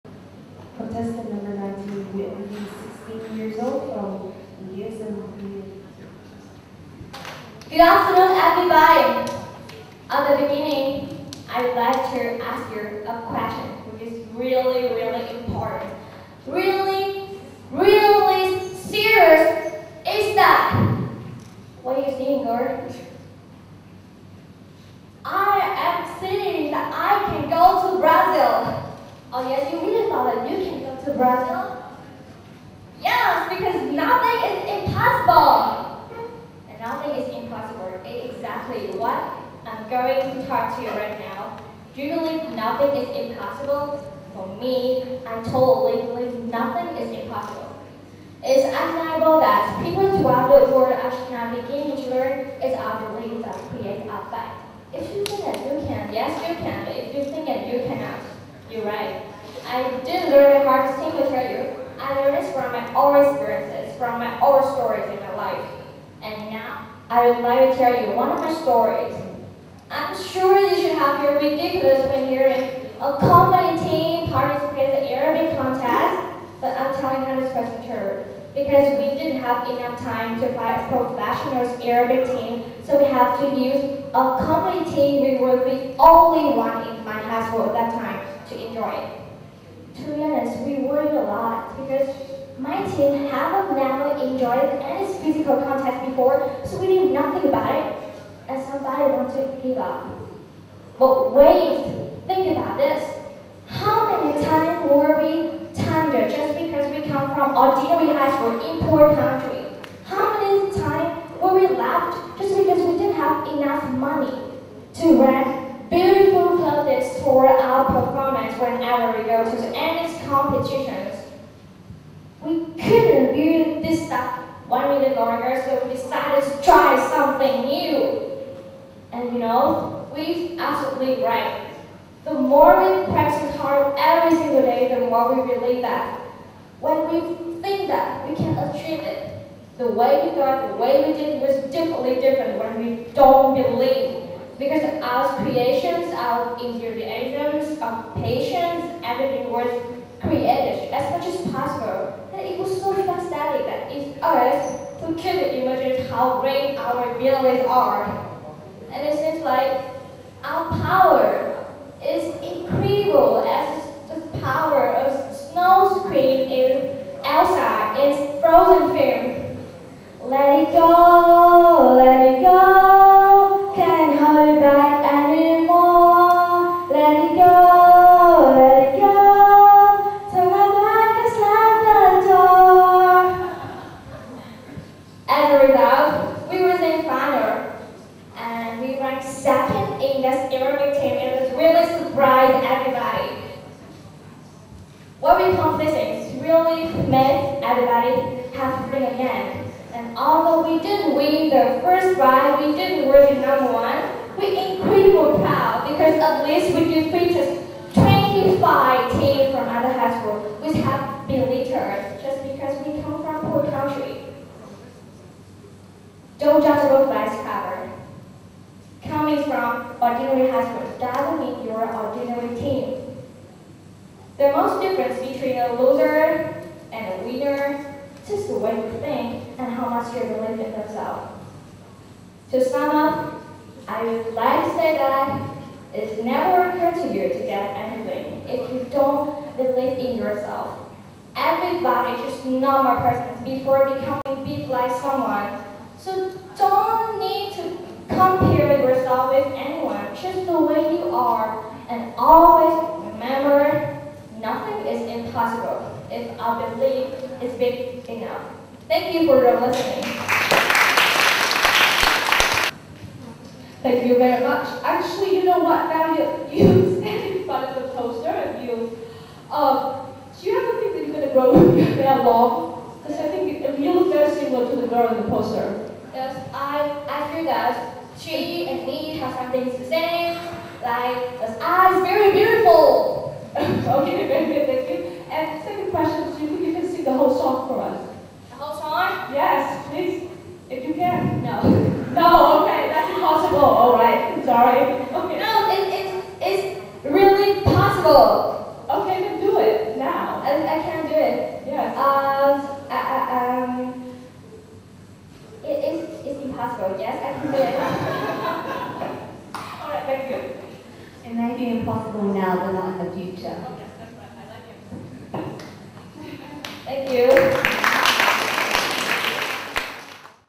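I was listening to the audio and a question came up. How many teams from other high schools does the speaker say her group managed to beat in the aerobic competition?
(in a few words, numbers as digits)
25.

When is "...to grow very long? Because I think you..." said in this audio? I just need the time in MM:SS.
04:31.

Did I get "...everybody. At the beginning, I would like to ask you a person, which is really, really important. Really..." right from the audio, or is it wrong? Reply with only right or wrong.
wrong.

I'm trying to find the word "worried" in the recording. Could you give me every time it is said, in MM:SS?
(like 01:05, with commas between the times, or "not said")
01:30.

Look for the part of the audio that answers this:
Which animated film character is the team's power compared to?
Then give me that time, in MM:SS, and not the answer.
02:47.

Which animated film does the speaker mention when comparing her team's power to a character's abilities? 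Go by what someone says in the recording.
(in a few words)
Frozen.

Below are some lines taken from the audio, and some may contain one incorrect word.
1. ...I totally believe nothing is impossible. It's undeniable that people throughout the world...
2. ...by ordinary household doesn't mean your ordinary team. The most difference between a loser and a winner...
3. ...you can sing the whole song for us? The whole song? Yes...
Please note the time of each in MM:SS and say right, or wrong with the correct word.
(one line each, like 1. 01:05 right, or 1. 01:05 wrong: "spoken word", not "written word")
1. 00:45 right
2. 03:37 right
3. 04:46 right.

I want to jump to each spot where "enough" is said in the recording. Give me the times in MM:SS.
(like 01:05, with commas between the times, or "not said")
01:19, 04:18.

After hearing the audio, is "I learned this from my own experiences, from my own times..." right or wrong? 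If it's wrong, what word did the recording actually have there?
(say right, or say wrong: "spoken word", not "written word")
wrong: "stories", not "times".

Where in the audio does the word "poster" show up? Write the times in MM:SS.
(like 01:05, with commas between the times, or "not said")
04:27, 04:35.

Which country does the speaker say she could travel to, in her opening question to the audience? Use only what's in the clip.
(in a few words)
Brazil.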